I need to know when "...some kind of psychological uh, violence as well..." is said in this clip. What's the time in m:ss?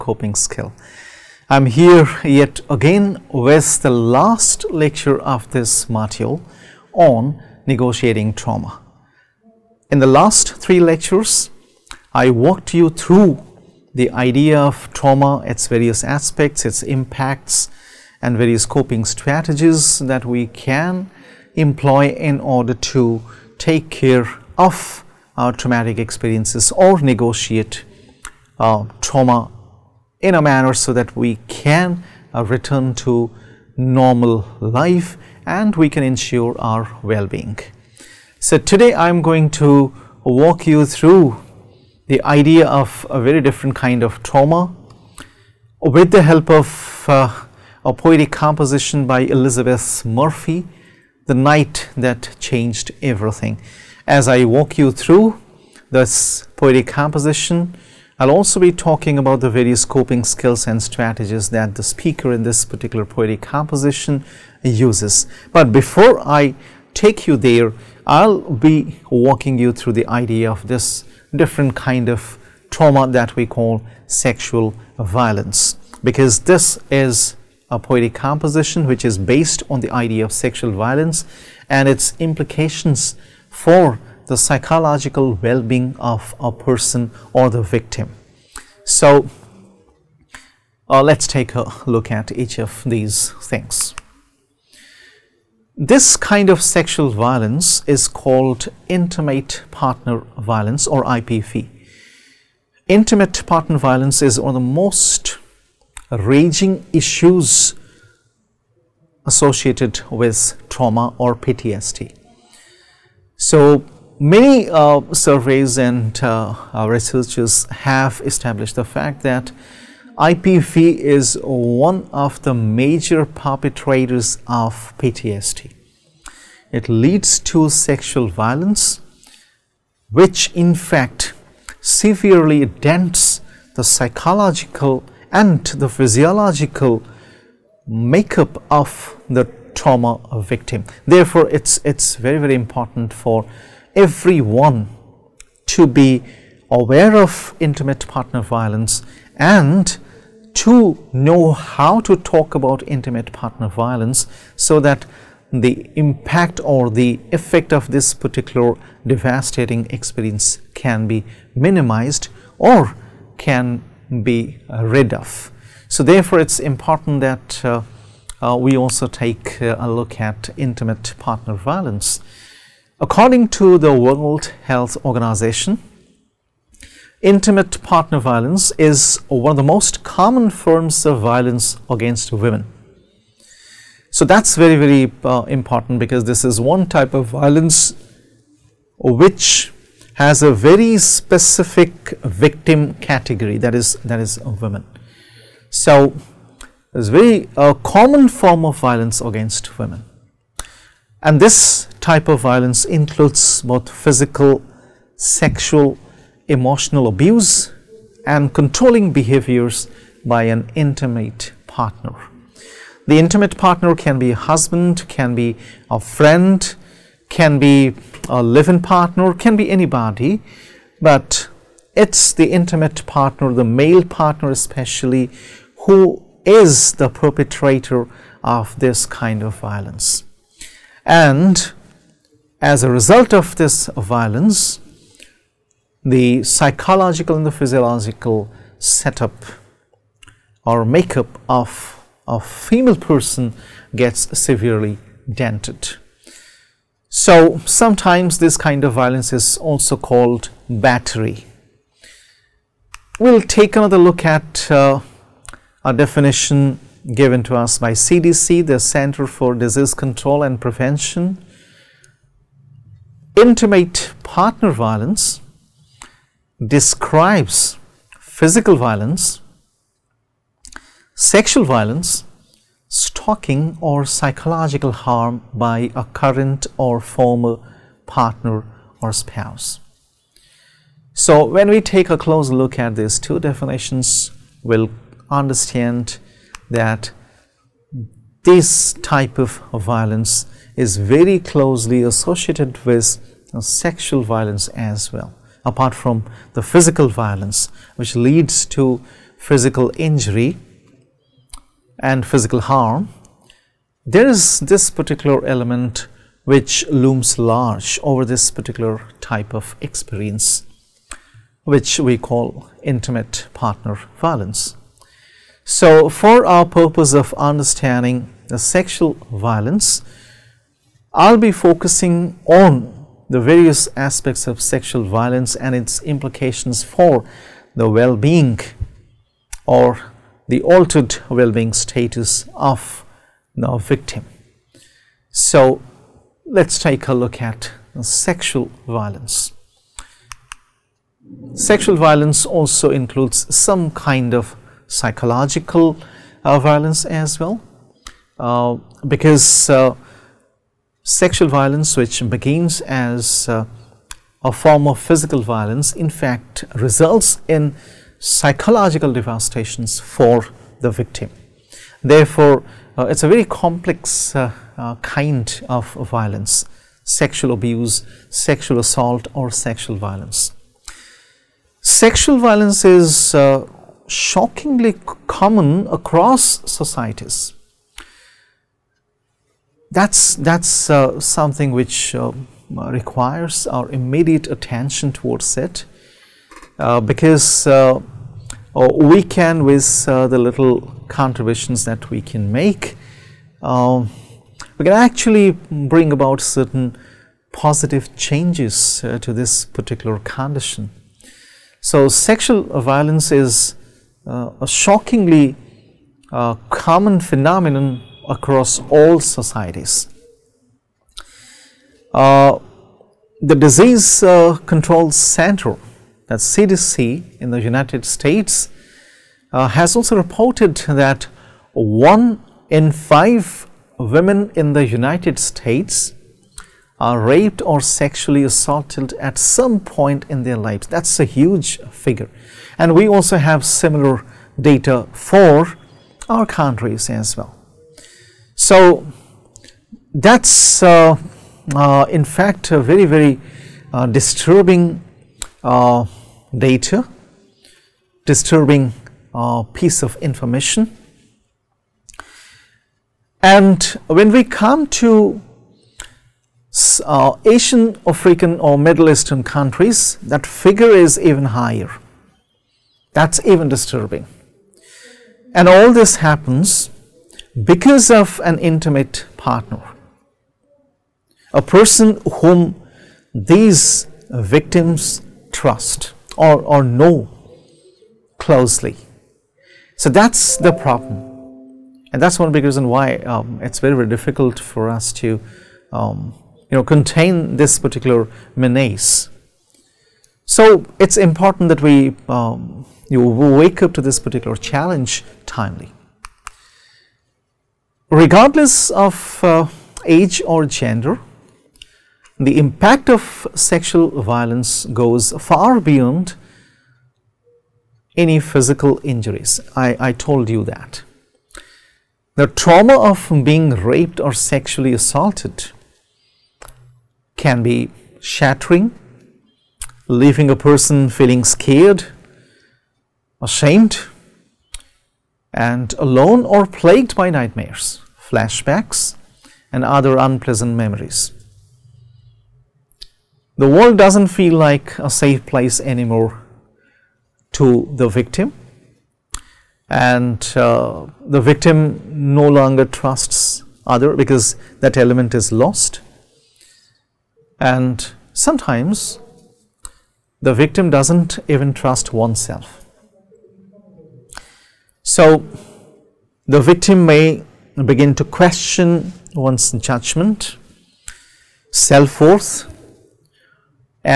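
5:43.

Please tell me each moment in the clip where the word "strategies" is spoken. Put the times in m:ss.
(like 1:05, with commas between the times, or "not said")
0:19, 1:00.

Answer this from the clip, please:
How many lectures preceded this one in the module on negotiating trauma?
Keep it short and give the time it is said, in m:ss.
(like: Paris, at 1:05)
three, at 0:10.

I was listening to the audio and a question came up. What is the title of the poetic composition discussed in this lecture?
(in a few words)
The Night That Changed Everything.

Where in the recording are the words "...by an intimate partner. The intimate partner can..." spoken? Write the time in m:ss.
3:30.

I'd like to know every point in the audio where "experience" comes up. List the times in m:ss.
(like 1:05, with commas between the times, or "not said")
0:25, 2:39, 5:09.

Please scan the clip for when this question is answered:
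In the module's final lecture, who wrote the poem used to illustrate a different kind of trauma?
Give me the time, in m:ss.
0:49.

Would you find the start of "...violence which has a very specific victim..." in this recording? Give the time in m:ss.
3:07.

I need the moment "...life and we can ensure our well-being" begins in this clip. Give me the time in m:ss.
0:34.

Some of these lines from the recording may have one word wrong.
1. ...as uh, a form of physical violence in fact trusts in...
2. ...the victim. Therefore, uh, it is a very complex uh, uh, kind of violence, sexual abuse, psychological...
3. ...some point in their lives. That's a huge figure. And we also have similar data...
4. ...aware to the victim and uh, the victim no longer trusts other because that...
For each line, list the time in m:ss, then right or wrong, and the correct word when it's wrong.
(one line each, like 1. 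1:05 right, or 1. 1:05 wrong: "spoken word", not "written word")
1. 5:52 wrong: "results", not "trusts"
2. 6:00 wrong: "sexual", not "psychological"
3. 7:09 right
4. 8:55 wrong: "anymore", not "aware".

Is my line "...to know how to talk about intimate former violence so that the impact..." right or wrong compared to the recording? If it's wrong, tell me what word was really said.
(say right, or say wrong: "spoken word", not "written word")
wrong: "partner", not "former".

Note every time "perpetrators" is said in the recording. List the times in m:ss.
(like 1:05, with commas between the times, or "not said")
2:03, 3:47.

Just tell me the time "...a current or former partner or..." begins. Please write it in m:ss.
4:35.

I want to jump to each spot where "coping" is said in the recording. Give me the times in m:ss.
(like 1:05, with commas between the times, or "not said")
0:18, 0:59.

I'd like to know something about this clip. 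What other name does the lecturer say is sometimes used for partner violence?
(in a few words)
battery.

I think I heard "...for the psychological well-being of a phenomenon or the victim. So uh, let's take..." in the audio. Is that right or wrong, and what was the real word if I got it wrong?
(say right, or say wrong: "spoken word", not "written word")
wrong: "person", not "phenomenon".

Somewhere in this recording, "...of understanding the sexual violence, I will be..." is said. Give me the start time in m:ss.
5:17.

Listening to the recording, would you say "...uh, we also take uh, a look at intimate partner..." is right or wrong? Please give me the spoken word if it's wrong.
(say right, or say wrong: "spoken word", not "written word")
right.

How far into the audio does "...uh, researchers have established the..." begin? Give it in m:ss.
1:56.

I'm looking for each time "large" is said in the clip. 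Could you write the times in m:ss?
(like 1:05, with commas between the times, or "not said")
5:07.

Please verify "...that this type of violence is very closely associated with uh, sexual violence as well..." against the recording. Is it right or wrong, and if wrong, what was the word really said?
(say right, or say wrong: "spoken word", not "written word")
right.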